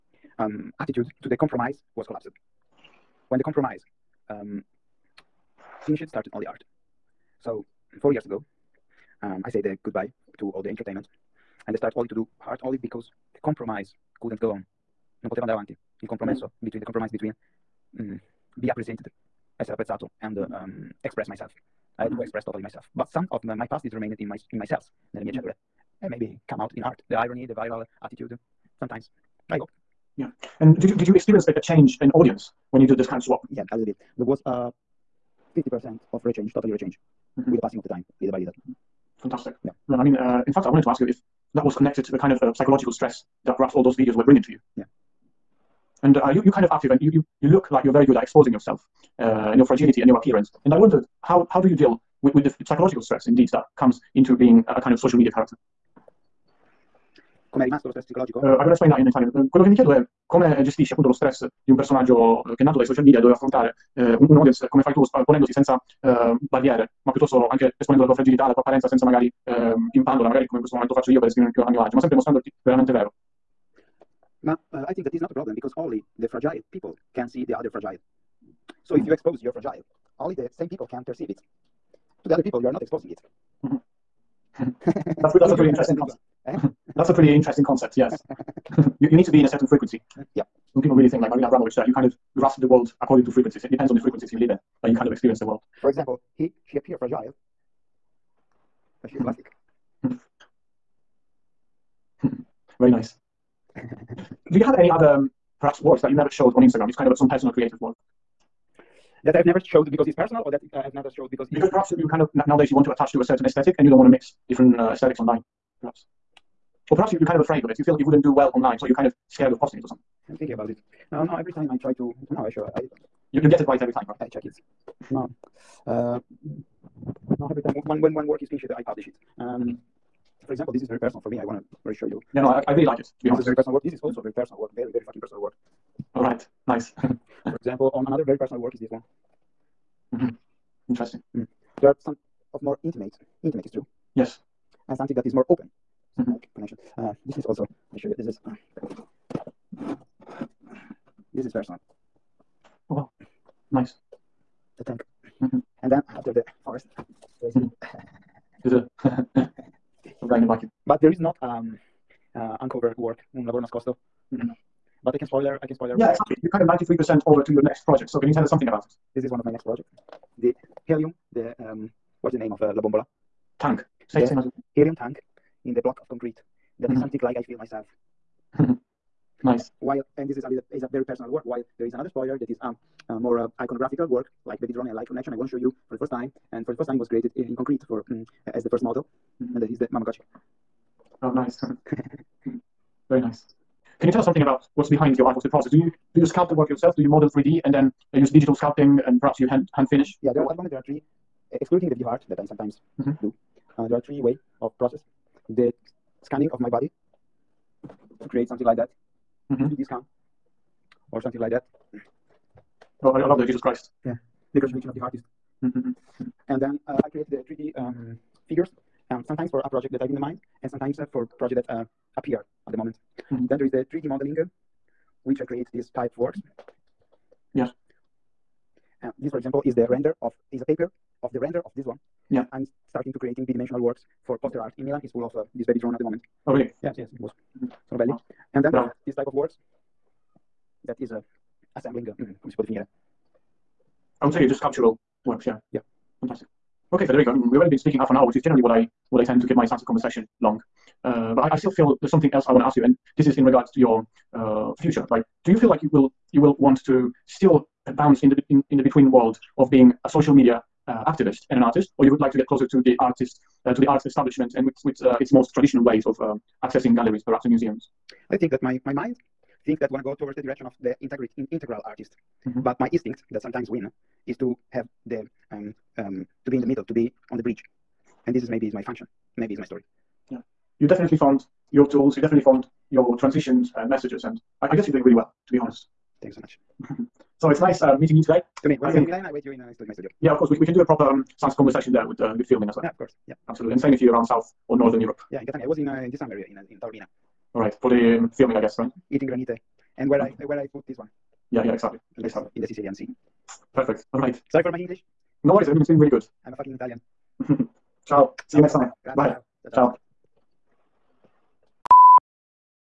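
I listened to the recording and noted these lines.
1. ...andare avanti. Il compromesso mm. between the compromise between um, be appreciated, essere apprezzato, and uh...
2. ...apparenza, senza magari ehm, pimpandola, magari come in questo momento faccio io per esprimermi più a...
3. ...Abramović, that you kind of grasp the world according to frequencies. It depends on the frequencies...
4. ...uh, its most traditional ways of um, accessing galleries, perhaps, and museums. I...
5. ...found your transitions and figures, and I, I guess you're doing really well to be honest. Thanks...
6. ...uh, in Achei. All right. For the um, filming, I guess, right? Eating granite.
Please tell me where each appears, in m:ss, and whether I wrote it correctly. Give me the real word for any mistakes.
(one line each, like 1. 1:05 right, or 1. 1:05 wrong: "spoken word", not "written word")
1. 0:15 right
2. 1:08 right
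3. 1:31 right
4. 4:25 right
5. 4:42 wrong: "messages", not "figures"
6. 4:56 wrong: "Taormina", not "Achei".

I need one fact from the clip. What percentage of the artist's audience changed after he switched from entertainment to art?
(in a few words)
50%.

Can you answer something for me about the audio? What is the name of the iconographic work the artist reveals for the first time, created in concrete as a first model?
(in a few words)
Mamagotchi.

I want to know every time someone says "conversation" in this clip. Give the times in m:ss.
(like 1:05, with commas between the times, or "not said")
4:09, 4:51.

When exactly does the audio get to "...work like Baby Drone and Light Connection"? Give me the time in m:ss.
3:04.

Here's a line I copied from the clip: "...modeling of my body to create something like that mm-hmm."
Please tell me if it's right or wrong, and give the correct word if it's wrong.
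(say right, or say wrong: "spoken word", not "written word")
wrong: "scanning", not "modeling".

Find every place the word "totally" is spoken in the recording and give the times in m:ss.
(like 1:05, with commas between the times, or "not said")
0:22, 0:36.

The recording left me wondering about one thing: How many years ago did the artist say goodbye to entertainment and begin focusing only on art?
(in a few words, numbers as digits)
4.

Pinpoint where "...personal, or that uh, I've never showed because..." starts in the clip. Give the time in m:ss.
1:50.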